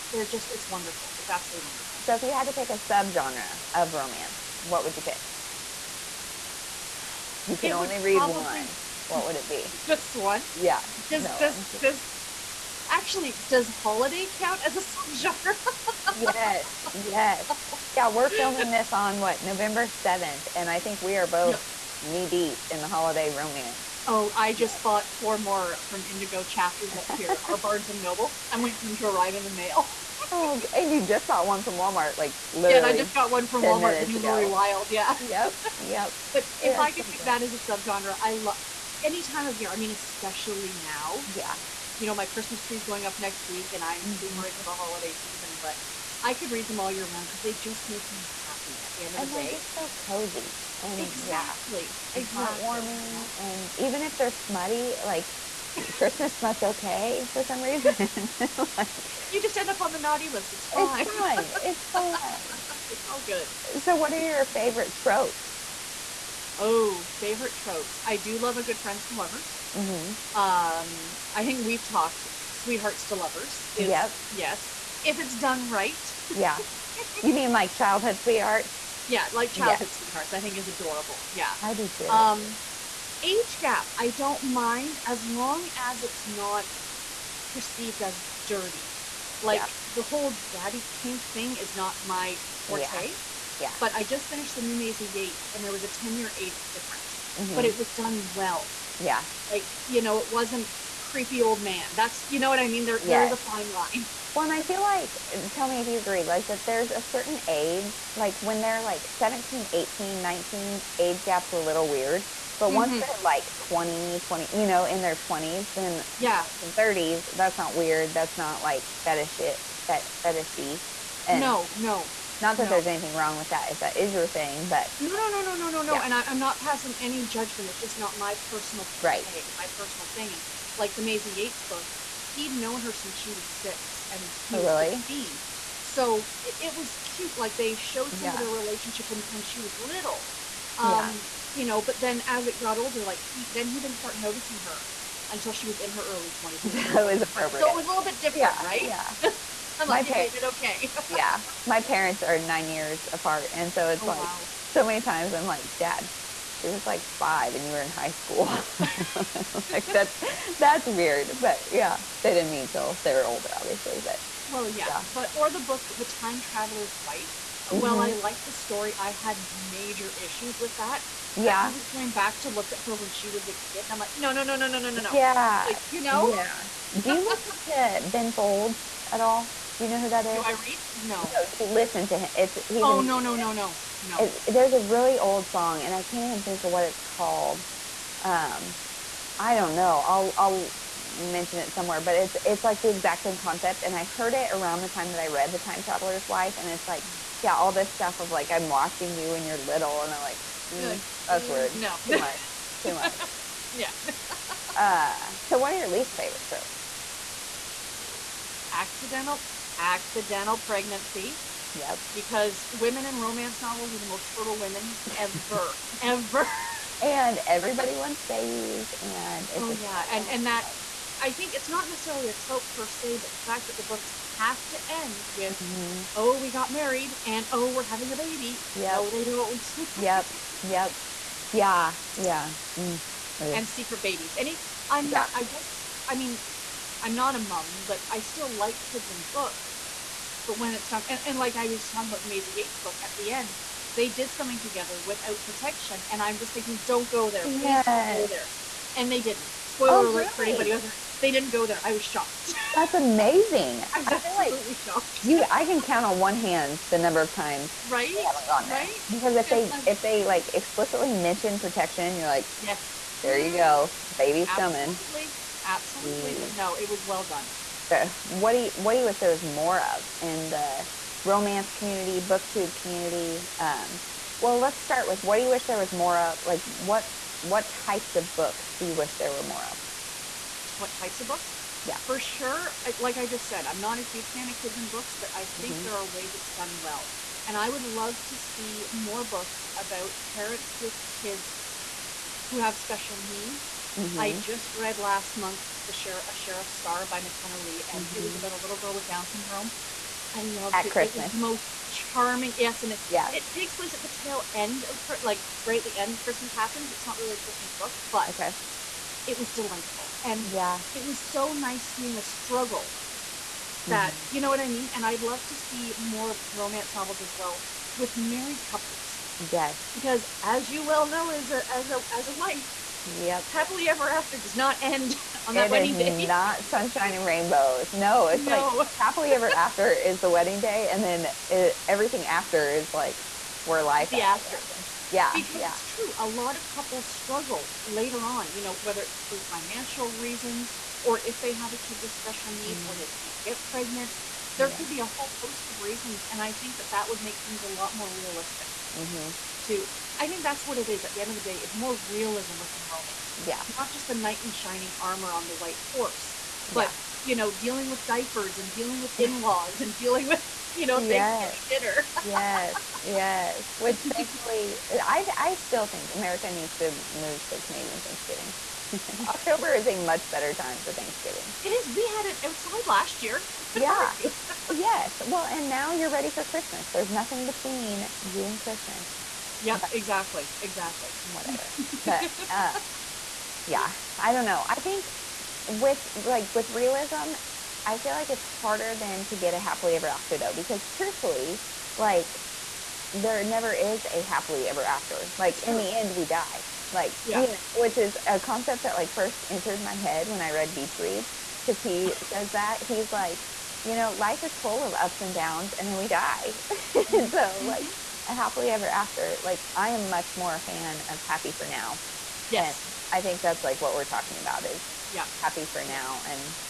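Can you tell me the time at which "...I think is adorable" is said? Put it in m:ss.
1:20.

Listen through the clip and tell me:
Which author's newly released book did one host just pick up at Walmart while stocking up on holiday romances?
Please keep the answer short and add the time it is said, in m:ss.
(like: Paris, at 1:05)
Lori Wilde, at 0:34.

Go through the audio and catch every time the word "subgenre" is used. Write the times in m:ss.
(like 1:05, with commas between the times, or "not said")
0:02, 0:15, 0:37.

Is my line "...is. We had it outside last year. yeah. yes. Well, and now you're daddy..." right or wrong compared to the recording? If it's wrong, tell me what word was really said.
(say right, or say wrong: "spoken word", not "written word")
wrong: "ready", not "daddy".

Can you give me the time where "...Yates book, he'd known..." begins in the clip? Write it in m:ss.
2:11.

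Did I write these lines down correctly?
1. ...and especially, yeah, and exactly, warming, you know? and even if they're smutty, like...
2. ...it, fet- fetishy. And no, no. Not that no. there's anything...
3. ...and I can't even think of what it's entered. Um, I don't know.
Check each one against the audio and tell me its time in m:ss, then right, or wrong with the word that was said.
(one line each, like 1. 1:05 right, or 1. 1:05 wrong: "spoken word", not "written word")
1. 0:50 wrong: "exactly", not "especially"
2. 1:59 right
3. 3:05 wrong: "called", not "entered".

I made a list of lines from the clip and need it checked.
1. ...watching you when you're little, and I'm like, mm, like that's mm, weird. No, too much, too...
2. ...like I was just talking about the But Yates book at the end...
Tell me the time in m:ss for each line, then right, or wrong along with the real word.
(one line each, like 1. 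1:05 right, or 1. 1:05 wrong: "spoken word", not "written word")
1. 3:18 right
2. 4:01 wrong: "Maisie", not "But".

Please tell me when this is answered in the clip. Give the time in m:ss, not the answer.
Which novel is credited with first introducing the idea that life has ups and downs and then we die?
6:40.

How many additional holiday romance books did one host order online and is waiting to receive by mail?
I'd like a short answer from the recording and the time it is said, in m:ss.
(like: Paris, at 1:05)
4, at 0:25.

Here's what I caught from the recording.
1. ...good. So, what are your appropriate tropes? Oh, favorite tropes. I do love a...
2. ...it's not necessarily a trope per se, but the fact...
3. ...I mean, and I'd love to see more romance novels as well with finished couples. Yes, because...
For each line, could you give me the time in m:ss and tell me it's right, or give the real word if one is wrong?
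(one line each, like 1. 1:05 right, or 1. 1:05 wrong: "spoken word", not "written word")
1. 1:03 wrong: "favorite", not "appropriate"
2. 3:41 right
3. 5:14 wrong: "married", not "finished".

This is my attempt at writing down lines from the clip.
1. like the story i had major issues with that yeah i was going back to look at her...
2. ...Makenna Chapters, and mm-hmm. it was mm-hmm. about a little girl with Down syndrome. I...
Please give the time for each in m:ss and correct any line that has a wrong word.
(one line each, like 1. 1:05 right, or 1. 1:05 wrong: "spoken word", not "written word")
1. 2:48 right
2. 4:57 wrong: "Lee", not "Chapters".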